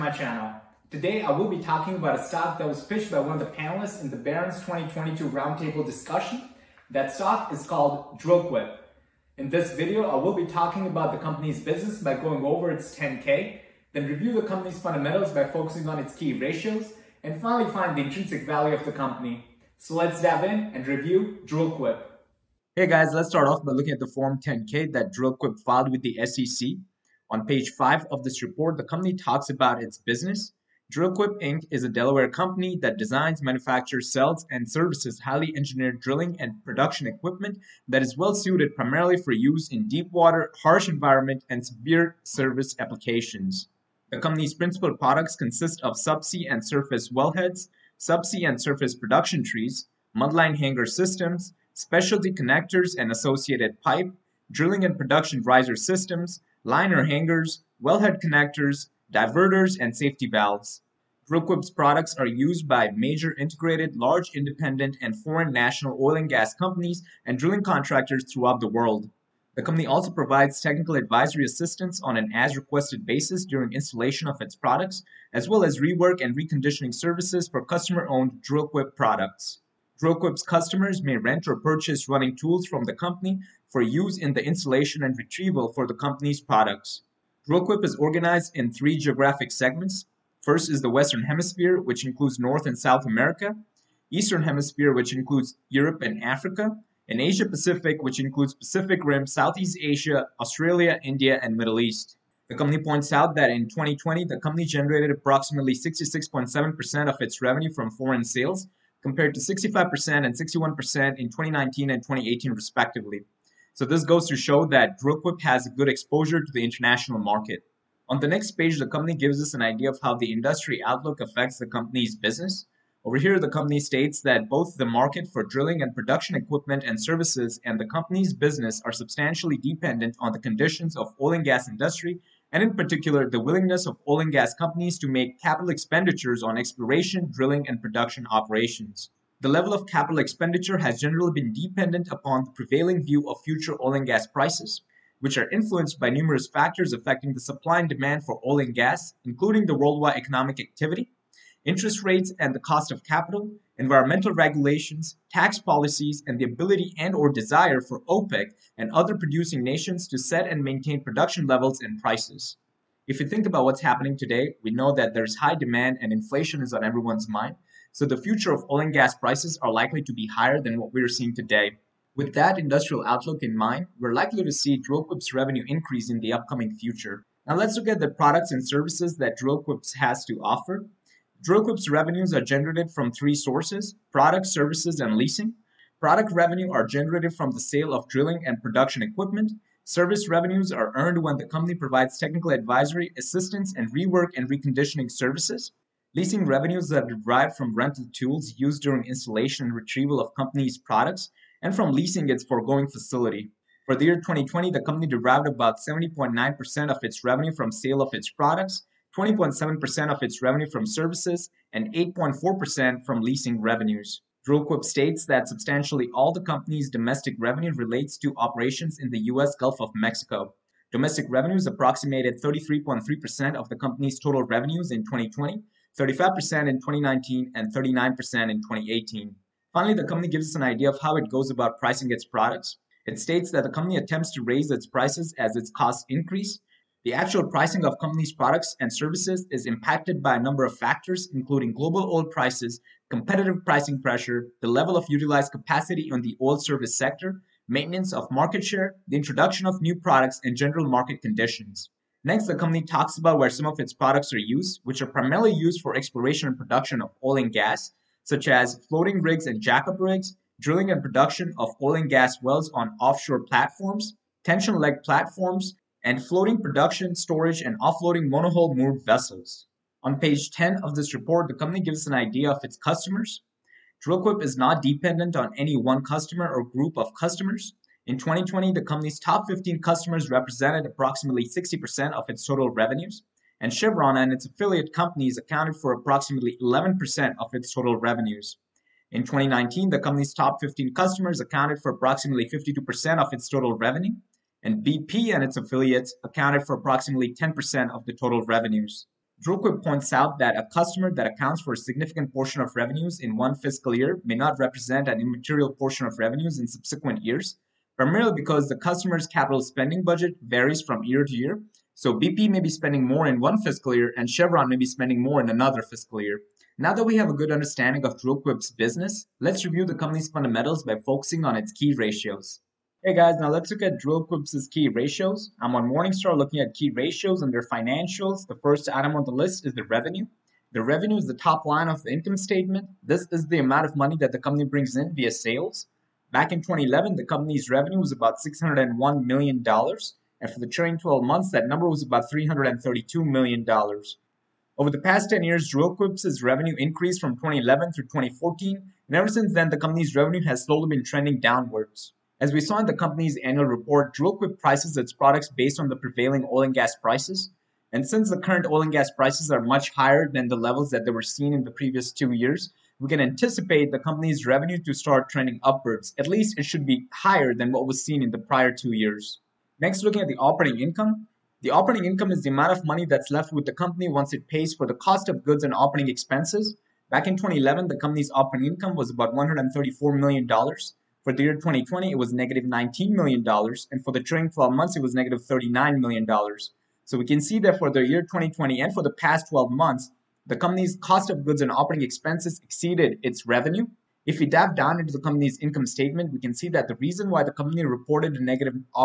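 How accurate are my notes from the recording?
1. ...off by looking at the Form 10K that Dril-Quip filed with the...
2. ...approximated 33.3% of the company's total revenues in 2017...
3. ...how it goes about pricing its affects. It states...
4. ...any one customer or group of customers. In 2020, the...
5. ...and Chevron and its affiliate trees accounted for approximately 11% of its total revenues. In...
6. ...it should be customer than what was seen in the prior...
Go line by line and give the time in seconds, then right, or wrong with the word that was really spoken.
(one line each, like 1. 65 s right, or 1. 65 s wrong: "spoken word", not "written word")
1. 23 s right
2. 221 s wrong: "2020", not "2017"
3. 231 s wrong: "products", not "affects"
4. 275 s right
5. 283 s wrong: "companies", not "trees"
6. 366 s wrong: "higher", not "customer".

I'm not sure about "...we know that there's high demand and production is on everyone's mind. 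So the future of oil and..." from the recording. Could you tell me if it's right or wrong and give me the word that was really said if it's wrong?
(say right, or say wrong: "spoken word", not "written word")
wrong: "inflation", not "production".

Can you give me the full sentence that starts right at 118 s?
On the next page, the company gives us an idea of how the industry outlook affects the company's business.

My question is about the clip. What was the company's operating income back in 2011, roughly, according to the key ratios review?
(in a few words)
$134 million.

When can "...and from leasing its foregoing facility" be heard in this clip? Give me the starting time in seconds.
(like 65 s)
201 s.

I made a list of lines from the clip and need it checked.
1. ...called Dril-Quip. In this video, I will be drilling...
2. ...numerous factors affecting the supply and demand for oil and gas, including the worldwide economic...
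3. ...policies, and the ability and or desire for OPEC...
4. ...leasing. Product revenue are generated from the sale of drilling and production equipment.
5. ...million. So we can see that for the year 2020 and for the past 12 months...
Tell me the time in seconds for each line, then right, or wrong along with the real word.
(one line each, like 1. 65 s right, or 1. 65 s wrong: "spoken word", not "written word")
1. 7 s wrong: "talking", not "drilling"
2. 146 s right
3. 155 s right
4. 185 s right
5. 385 s right.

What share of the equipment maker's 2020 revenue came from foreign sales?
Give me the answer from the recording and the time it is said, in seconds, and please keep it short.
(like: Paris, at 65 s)
66.7%, at 105 s.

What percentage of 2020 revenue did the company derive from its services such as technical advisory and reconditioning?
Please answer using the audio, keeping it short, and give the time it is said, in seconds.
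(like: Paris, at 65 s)
20.7%, at 209 s.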